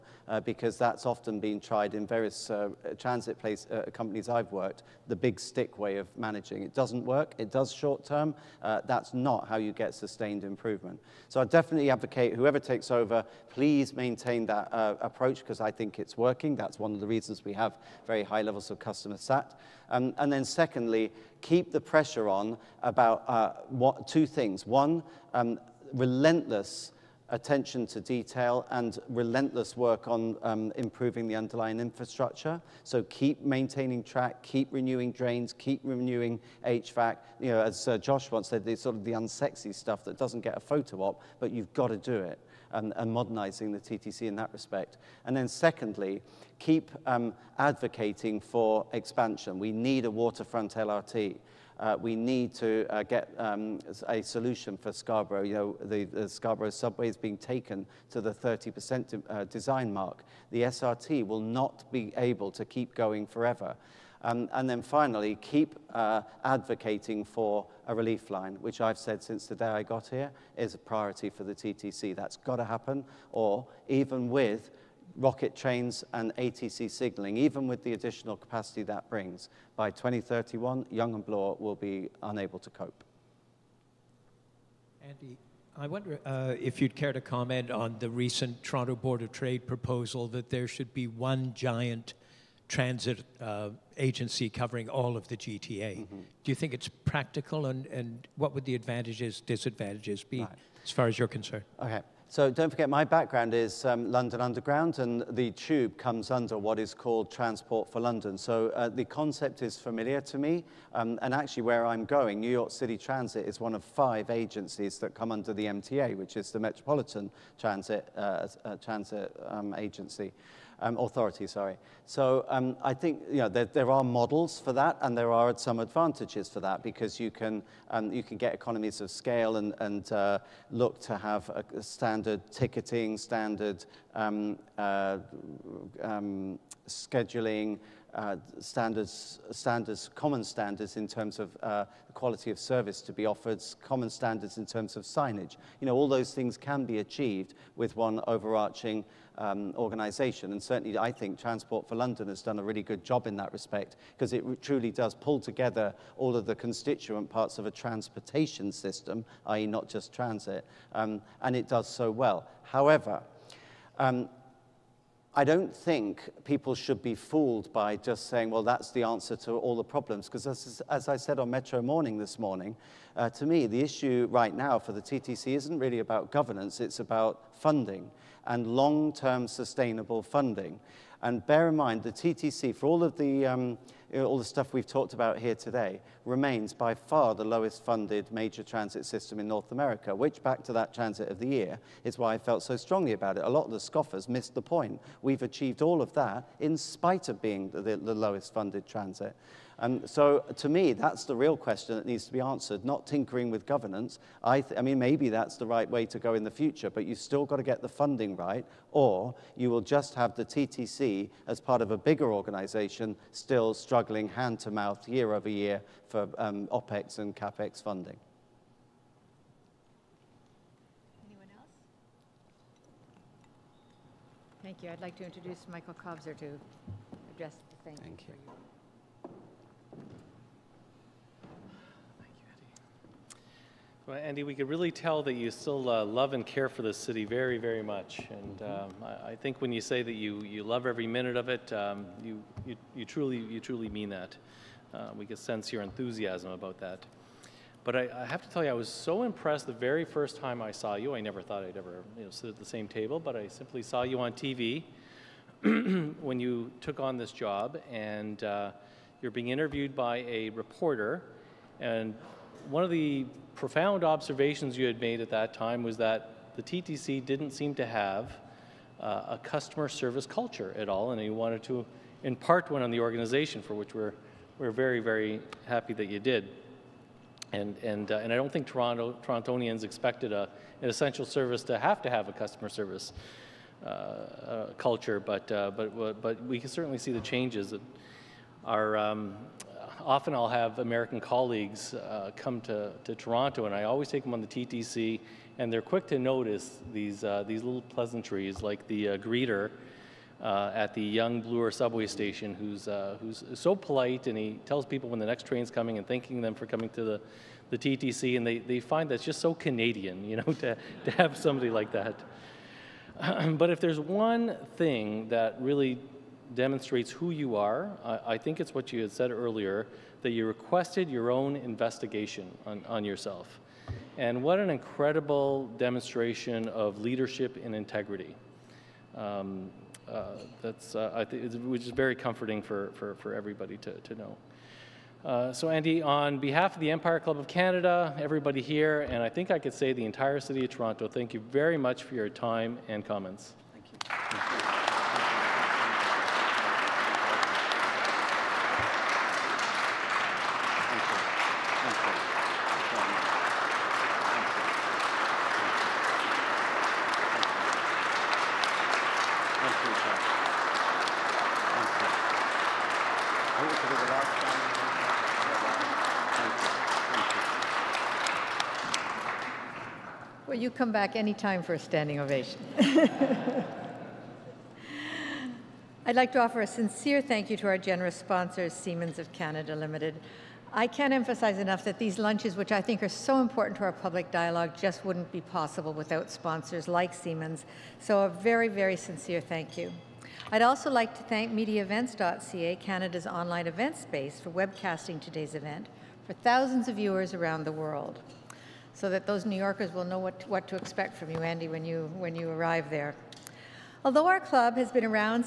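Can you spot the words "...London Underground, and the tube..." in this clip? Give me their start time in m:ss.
1:44.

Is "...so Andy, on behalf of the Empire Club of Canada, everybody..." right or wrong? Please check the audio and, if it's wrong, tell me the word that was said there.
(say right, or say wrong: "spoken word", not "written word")
right.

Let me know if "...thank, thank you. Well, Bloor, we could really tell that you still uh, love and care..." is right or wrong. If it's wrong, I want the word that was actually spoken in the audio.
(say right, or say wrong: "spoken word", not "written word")
wrong: "Andy", not "Bloor".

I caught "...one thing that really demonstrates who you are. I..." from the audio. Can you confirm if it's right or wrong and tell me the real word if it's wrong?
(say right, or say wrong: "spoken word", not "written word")
right.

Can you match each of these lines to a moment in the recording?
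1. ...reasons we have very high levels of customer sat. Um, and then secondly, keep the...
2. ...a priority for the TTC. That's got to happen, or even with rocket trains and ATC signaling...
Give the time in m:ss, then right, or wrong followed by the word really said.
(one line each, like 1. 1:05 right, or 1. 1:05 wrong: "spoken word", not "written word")
1. 0:17 right
2. 1:10 right.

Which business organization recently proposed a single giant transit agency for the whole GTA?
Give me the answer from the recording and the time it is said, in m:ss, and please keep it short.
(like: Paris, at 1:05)
Toronto Board of Trade, at 1:28.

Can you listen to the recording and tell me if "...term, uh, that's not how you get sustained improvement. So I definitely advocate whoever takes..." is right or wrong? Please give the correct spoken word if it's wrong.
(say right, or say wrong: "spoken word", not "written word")
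right.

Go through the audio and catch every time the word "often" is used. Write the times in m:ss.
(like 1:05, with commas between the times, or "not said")
0:01, 4:50.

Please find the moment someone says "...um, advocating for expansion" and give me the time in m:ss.
0:47.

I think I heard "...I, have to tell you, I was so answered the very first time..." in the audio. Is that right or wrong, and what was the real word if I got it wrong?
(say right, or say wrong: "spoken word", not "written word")
wrong: "impressed", not "answered".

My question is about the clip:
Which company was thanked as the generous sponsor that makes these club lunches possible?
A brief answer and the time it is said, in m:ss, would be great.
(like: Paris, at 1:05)
Siemens of Canada Limited, at 6:18.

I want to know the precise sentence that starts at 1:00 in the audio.
The SRT will not be able to keep going forever.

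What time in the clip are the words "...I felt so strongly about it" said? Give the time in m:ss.
3:12.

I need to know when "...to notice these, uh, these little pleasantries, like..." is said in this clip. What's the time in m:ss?
4:56.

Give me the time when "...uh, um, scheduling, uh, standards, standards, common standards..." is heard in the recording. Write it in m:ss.
2:14.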